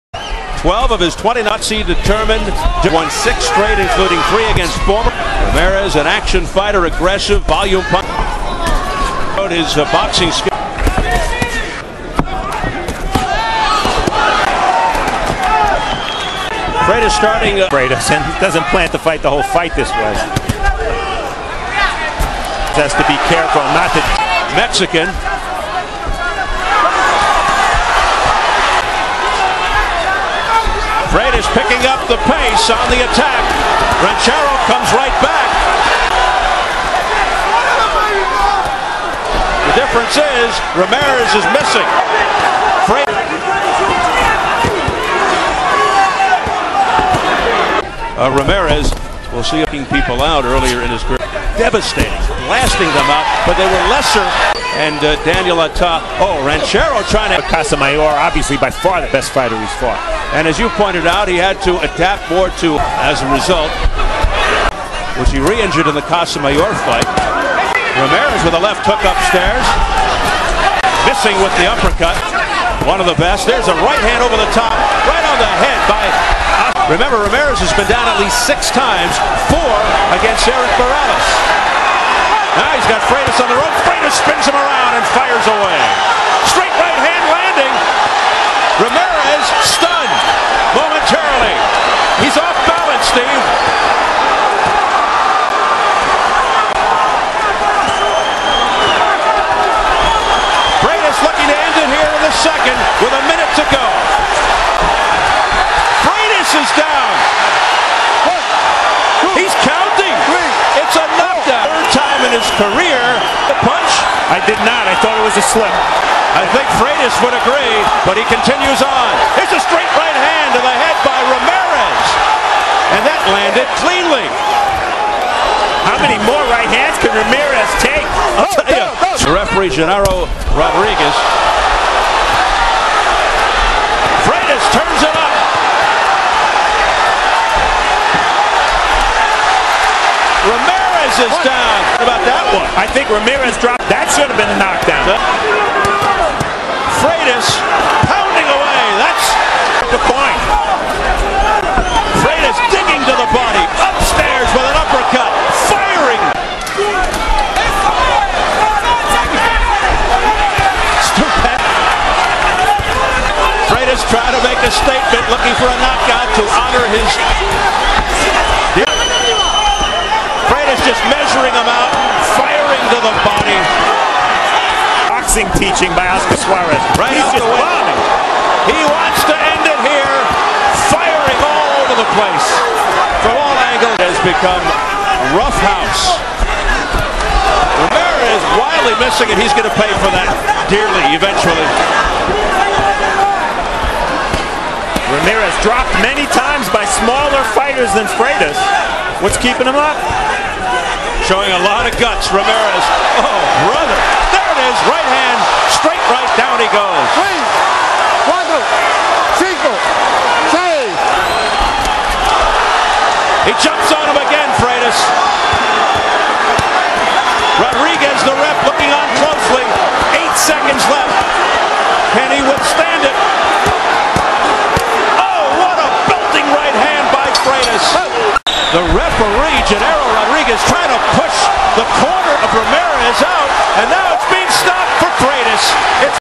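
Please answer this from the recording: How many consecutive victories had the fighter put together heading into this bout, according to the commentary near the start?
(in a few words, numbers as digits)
6.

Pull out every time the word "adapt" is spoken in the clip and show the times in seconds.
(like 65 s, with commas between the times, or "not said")
61 s.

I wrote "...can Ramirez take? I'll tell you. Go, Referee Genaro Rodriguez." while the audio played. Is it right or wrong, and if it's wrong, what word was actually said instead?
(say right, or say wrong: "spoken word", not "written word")
right.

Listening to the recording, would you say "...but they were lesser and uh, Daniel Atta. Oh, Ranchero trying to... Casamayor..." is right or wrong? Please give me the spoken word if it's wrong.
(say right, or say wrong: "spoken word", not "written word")
right.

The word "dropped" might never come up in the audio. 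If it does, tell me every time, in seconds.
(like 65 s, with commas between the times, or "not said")
143 s, 195 s.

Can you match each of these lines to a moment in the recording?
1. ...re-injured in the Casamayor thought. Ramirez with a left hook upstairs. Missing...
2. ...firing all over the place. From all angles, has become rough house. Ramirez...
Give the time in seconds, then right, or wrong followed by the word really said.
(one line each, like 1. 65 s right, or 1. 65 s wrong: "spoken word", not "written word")
1. 65 s wrong: "fight", not "thought"
2. 180 s right.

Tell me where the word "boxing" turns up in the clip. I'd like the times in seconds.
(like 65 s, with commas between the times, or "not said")
9 s, 175 s.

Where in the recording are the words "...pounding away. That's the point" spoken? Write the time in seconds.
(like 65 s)
148 s.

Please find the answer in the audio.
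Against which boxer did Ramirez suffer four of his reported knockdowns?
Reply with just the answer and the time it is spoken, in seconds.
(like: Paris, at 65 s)
Erik Morales, at 80 s.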